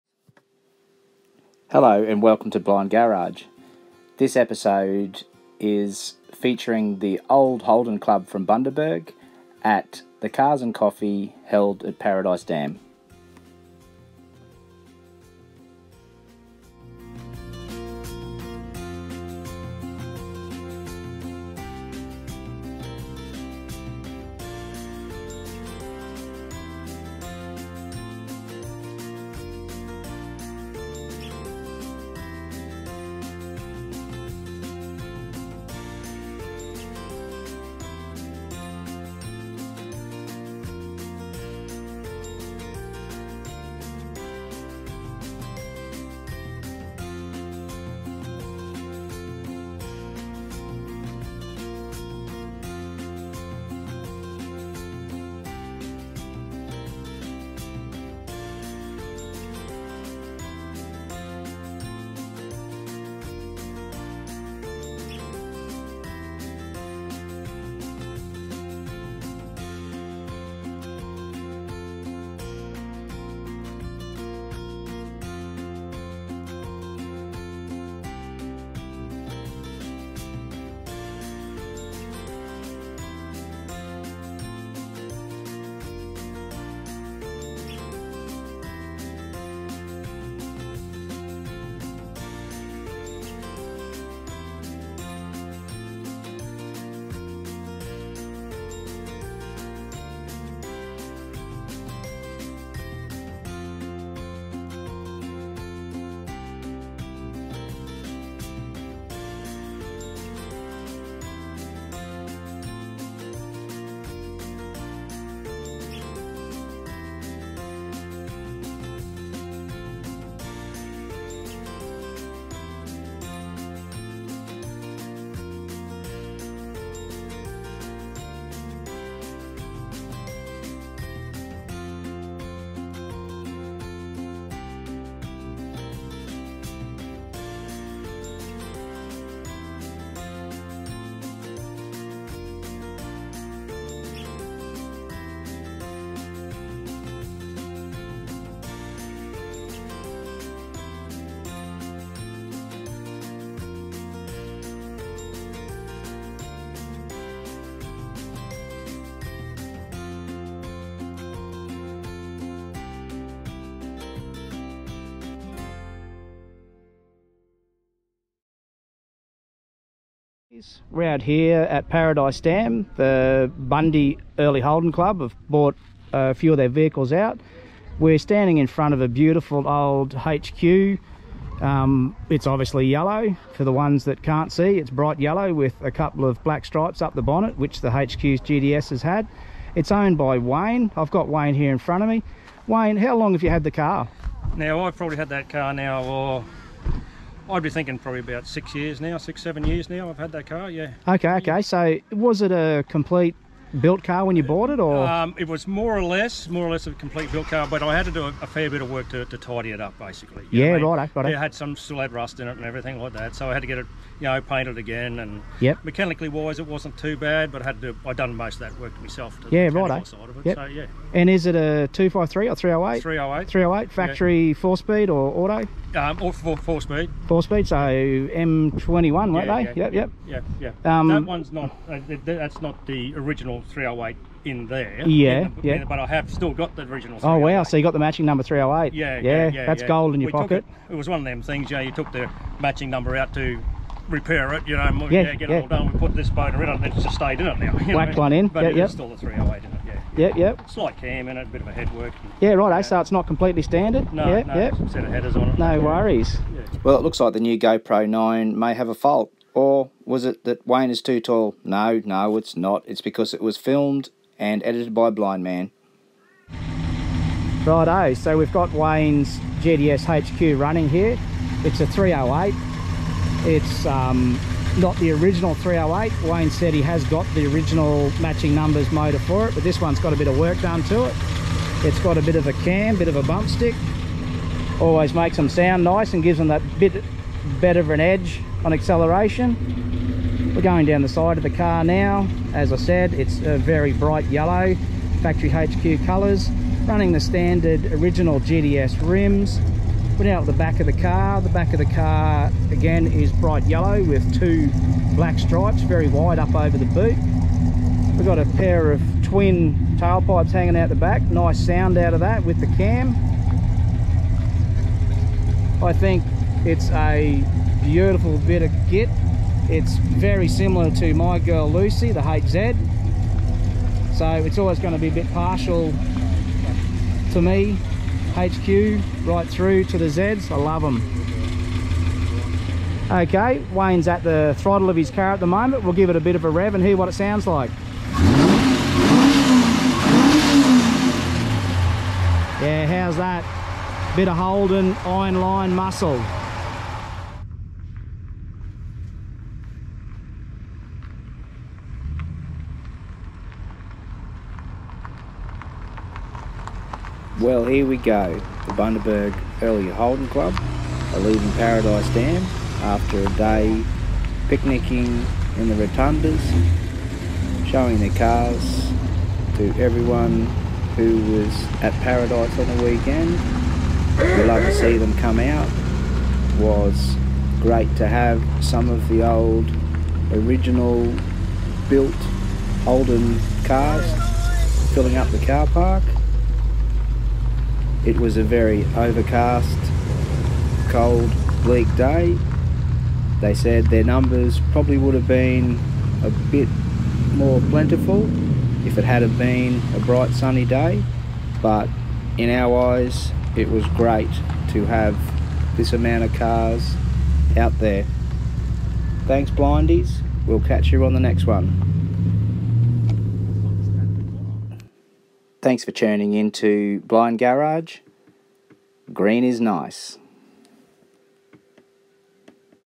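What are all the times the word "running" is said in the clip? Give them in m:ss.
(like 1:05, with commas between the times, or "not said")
4:30, 4:56.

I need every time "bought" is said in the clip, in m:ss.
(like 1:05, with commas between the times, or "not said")
2:55, 3:24.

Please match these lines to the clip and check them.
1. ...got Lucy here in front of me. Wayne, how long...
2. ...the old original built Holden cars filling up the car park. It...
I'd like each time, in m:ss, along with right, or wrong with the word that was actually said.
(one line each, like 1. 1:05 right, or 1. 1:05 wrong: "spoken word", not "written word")
1. 3:11 wrong: "Wayne", not "Lucy"
2. 6:19 right.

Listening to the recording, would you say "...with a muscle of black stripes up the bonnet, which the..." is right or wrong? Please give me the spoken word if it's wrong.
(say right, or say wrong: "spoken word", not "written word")
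wrong: "couple", not "muscle".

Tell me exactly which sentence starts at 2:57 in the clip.
We're standing in front of a beautiful old HQ.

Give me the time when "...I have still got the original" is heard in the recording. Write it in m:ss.
3:55.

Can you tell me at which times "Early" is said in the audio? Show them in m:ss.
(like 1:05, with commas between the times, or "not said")
2:54, 5:59.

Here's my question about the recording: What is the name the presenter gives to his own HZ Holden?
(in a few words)
Lucy.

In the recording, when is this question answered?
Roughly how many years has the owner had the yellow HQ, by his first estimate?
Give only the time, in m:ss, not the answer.
3:18.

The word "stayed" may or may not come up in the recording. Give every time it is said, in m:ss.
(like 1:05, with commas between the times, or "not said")
4:07.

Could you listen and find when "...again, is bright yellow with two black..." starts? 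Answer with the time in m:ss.
5:02.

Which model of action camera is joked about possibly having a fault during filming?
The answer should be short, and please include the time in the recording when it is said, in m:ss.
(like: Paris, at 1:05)
GoPro 9, at 4:17.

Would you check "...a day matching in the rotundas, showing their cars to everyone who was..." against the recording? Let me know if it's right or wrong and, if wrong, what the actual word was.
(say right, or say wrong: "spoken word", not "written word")
wrong: "picnicking", not "matching".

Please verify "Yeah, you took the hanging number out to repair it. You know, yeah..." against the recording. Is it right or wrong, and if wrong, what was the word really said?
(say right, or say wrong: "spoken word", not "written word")
wrong: "matching", not "hanging".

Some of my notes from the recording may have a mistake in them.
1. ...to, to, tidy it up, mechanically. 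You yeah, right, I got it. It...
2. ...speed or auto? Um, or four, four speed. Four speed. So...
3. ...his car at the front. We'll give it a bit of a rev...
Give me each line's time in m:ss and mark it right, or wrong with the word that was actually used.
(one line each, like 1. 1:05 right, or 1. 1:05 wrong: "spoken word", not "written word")
1. 3:29 wrong: "basically", not "mechanically"
2. 3:44 right
3. 5:34 wrong: "moment", not "front".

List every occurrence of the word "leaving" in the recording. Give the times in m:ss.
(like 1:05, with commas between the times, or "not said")
6:01.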